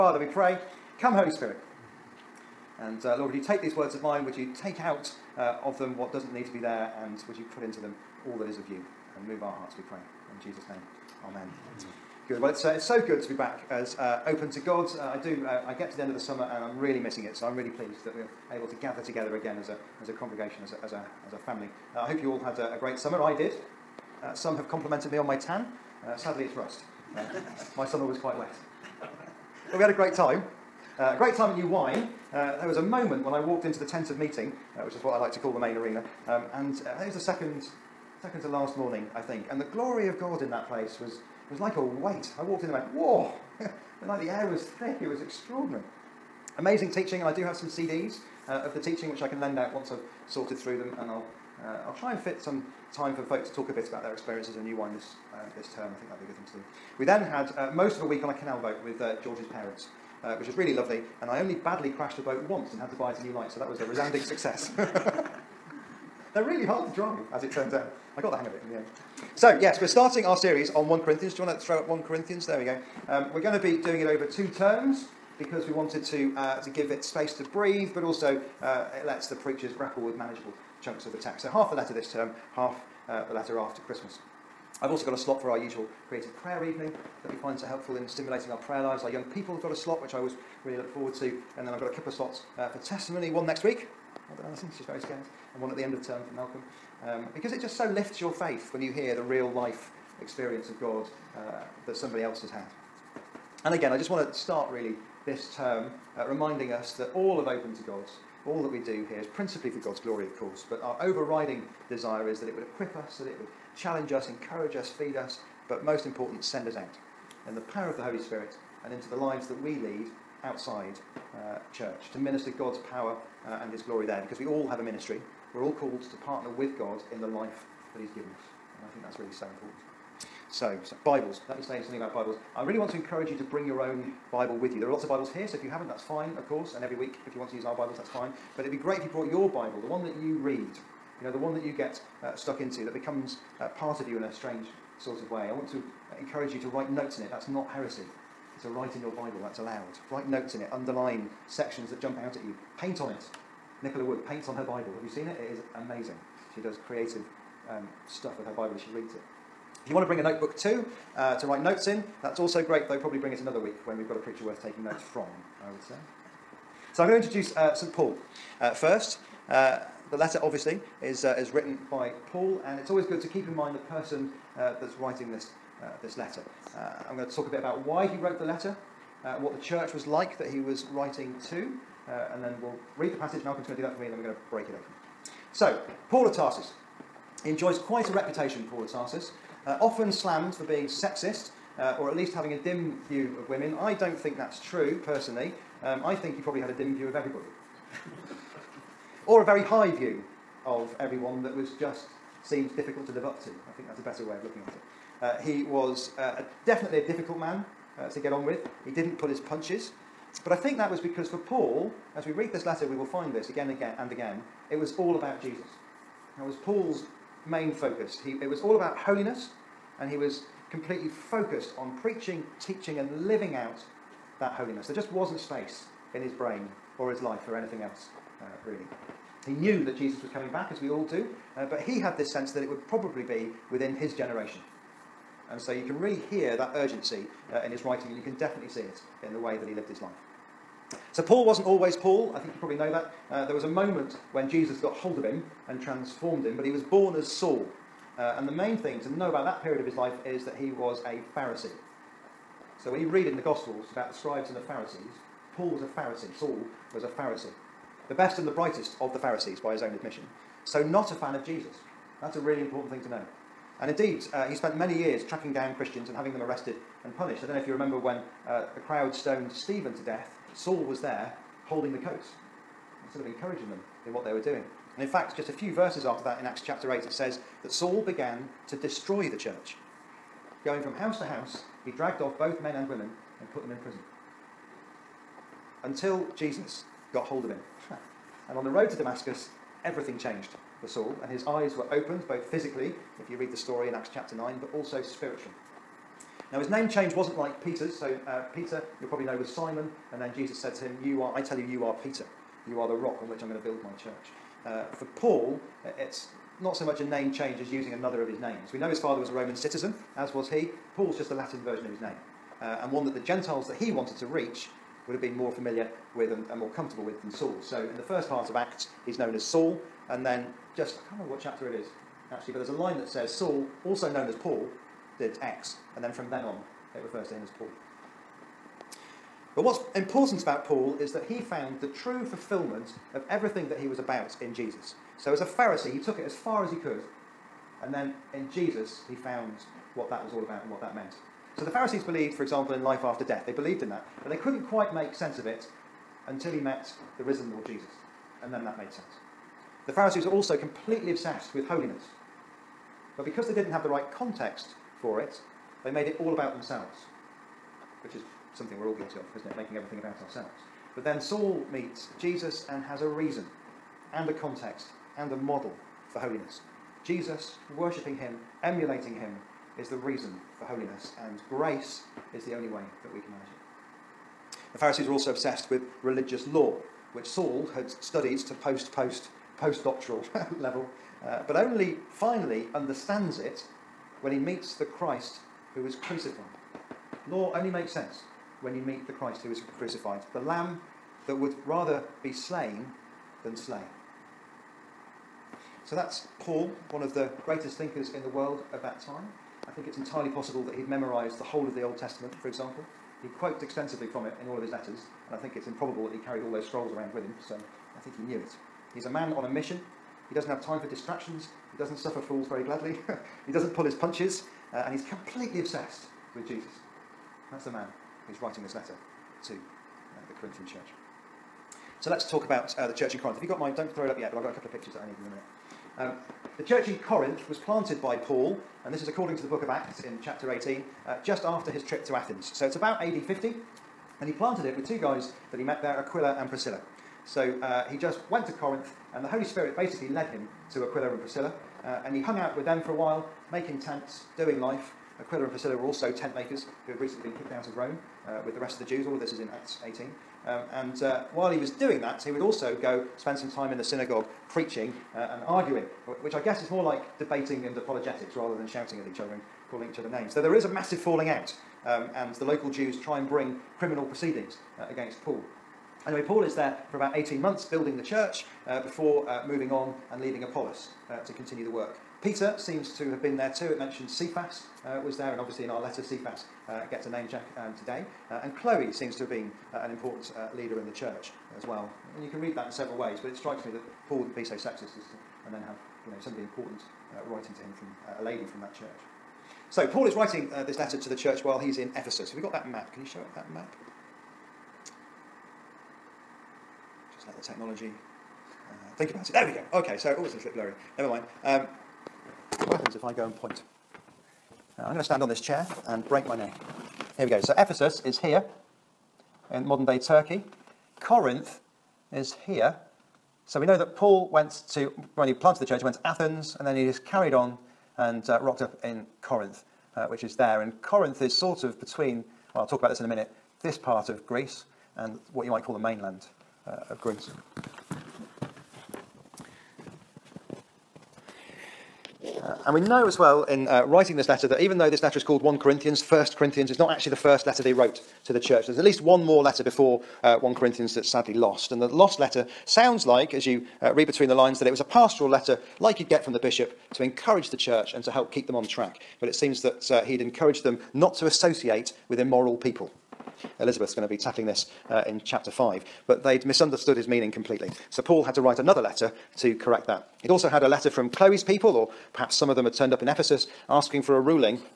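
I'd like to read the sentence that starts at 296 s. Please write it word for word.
Now, his name change wasn't like Peter's.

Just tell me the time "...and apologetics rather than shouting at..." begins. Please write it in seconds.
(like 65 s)
457 s.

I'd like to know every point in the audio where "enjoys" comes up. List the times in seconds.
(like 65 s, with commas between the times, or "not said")
187 s.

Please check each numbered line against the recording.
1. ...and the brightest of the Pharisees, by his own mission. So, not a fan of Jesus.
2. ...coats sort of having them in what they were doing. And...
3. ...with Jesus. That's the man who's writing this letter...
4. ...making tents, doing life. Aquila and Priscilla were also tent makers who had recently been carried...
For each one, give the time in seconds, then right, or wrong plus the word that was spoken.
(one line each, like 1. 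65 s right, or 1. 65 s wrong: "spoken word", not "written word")
1. 258 s wrong: "admission", not "mission"
2. 271 s wrong: "encouraging", not "having"
3. 416 s right
4. 443 s wrong: "kicked", not "carried".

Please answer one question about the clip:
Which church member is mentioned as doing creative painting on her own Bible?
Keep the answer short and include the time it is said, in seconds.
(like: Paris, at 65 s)
Nicola Wood, at 153 s.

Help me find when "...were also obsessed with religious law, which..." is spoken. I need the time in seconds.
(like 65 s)
375 s.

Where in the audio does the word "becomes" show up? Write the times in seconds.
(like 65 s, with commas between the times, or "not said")
142 s.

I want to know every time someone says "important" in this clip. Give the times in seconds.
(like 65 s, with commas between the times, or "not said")
116 s, 129 s, 262 s, 329 s, 479 s, 486 s.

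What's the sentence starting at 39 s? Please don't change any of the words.
And the glory of God in that place was, was like a weight.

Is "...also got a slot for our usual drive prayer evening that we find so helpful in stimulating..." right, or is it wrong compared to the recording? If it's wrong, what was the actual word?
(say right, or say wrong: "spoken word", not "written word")
wrong: "creative", not "drive".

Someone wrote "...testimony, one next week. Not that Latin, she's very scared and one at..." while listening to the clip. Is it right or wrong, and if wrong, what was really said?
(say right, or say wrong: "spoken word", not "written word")
wrong: "Alison", not "Latin".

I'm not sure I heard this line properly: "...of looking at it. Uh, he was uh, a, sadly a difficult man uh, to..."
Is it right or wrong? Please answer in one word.
wrong.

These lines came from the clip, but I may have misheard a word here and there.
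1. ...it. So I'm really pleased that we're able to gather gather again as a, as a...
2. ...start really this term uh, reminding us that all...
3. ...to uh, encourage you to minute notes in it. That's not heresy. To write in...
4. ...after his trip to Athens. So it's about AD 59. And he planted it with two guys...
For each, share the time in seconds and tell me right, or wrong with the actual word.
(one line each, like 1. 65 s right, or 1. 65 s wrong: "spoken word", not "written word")
1. 17 s wrong: "together", not "gather"
2. 104 s right
3. 145 s wrong: "write", not "minute"
4. 431 s wrong: "50", not "59".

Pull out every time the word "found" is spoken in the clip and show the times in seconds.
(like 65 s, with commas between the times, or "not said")
331 s, 339 s.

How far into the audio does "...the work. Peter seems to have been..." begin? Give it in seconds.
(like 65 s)
471 s.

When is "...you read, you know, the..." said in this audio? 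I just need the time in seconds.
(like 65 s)
140 s.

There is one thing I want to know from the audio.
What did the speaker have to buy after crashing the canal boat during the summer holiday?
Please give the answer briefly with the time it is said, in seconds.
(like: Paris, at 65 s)
A new light, at 63 s.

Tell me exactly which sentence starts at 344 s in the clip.
But they couldn't quite make sense of it until he met the risen Lord Jesus.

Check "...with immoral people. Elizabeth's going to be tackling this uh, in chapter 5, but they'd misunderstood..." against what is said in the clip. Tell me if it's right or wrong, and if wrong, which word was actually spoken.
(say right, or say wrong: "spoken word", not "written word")
right.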